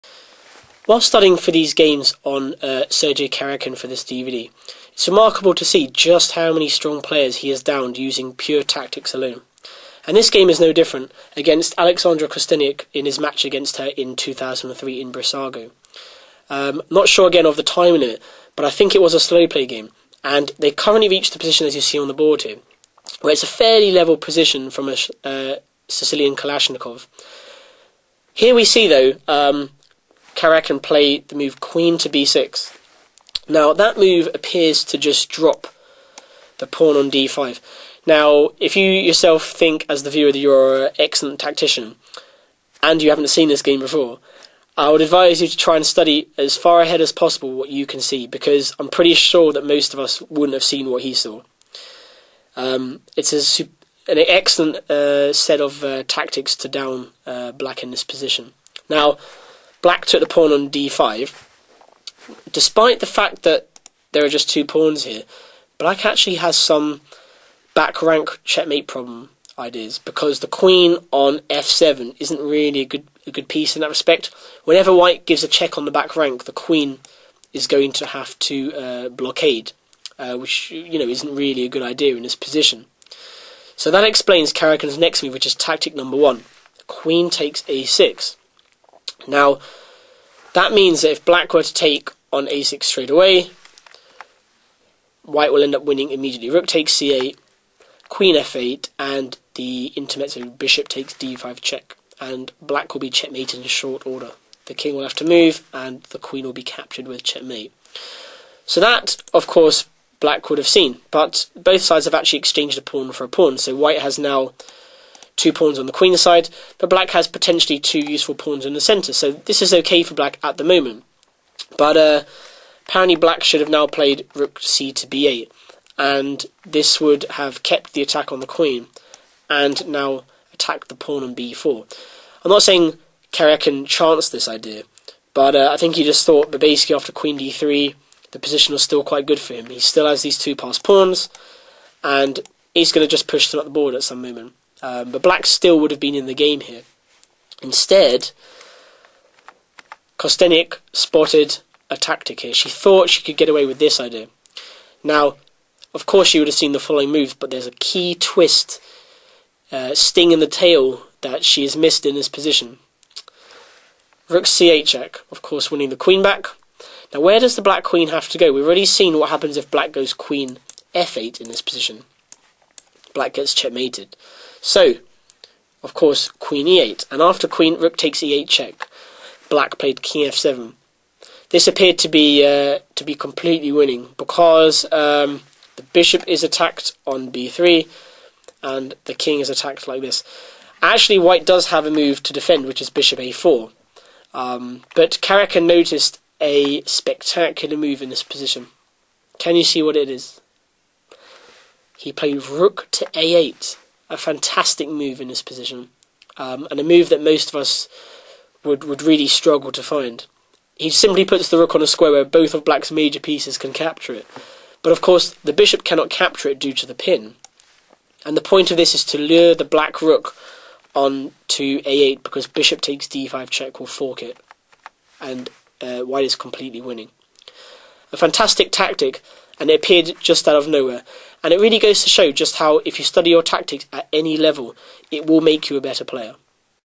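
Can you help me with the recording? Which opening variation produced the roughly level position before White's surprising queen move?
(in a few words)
Sicilian Kalashnikov.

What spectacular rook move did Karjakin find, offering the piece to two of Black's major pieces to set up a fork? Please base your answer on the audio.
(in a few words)
Rook to a8.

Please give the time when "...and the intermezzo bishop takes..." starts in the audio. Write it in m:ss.
1:38.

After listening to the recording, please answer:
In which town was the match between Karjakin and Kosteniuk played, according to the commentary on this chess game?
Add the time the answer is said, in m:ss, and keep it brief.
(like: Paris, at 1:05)
Brissago, at 0:15.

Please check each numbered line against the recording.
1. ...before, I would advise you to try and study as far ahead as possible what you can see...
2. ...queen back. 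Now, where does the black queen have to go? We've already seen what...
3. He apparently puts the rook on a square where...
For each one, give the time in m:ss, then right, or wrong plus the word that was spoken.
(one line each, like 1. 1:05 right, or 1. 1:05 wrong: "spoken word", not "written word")
1. 0:43 right
2. 2:45 right
3. 3:30 wrong: "simply", not "apparently".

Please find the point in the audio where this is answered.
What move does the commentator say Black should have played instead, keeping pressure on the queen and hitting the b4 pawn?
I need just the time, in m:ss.
2:04.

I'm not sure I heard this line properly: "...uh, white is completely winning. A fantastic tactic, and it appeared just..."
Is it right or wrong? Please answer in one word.
right.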